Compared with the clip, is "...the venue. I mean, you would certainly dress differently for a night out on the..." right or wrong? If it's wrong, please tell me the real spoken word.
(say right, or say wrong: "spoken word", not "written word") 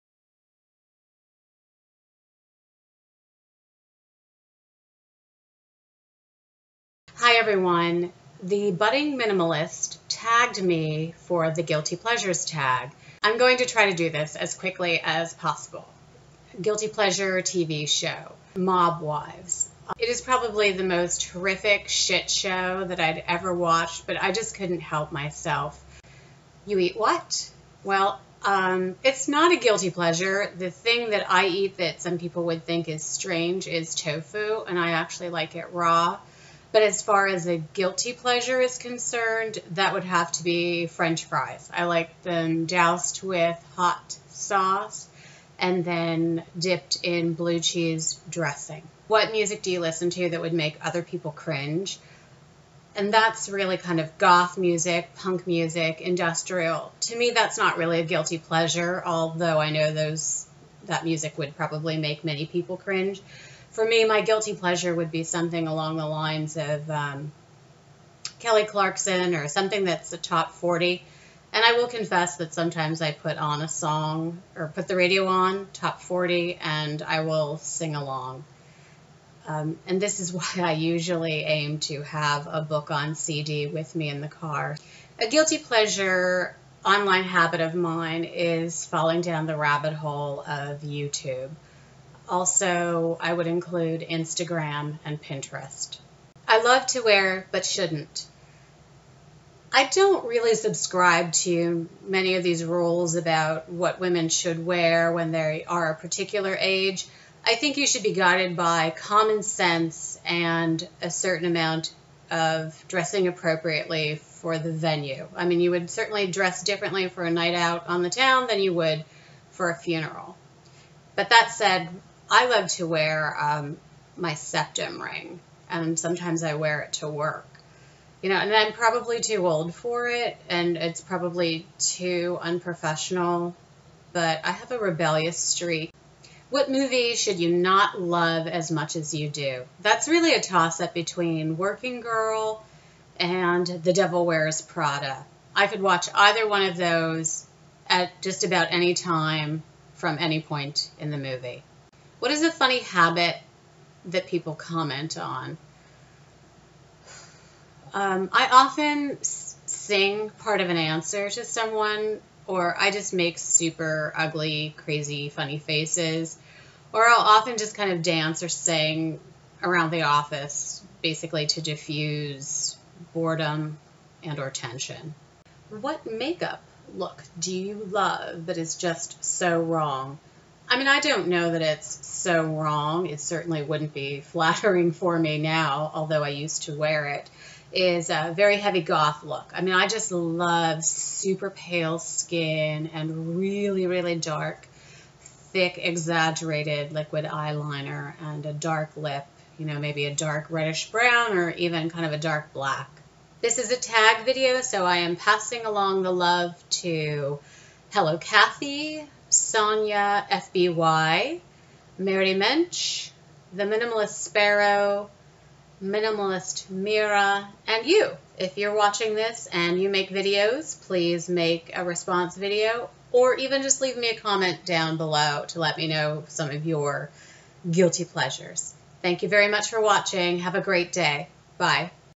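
right.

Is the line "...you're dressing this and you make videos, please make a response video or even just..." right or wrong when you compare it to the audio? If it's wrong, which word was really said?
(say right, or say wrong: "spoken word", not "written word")
wrong: "watching", not "dressing".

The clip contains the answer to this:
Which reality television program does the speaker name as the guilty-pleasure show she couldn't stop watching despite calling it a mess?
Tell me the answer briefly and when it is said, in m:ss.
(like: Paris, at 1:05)
Mob Wives, at 0:18.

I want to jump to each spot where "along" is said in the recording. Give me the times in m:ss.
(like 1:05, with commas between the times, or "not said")
1:05, 1:17, 3:25.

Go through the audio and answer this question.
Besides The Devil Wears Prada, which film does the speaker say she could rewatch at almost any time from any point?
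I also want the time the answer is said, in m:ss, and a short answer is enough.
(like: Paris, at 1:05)
Working Girl, at 2:21.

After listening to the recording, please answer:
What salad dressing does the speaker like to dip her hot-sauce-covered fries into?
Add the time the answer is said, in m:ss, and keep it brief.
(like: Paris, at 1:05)
blue cheese dressing, at 0:47.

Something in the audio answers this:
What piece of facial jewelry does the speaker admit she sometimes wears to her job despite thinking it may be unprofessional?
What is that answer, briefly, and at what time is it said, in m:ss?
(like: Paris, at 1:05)
septum ring, at 2:04.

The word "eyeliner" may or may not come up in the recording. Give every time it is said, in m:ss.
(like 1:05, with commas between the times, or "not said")
3:17.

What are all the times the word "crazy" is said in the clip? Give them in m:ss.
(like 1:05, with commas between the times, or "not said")
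2:44.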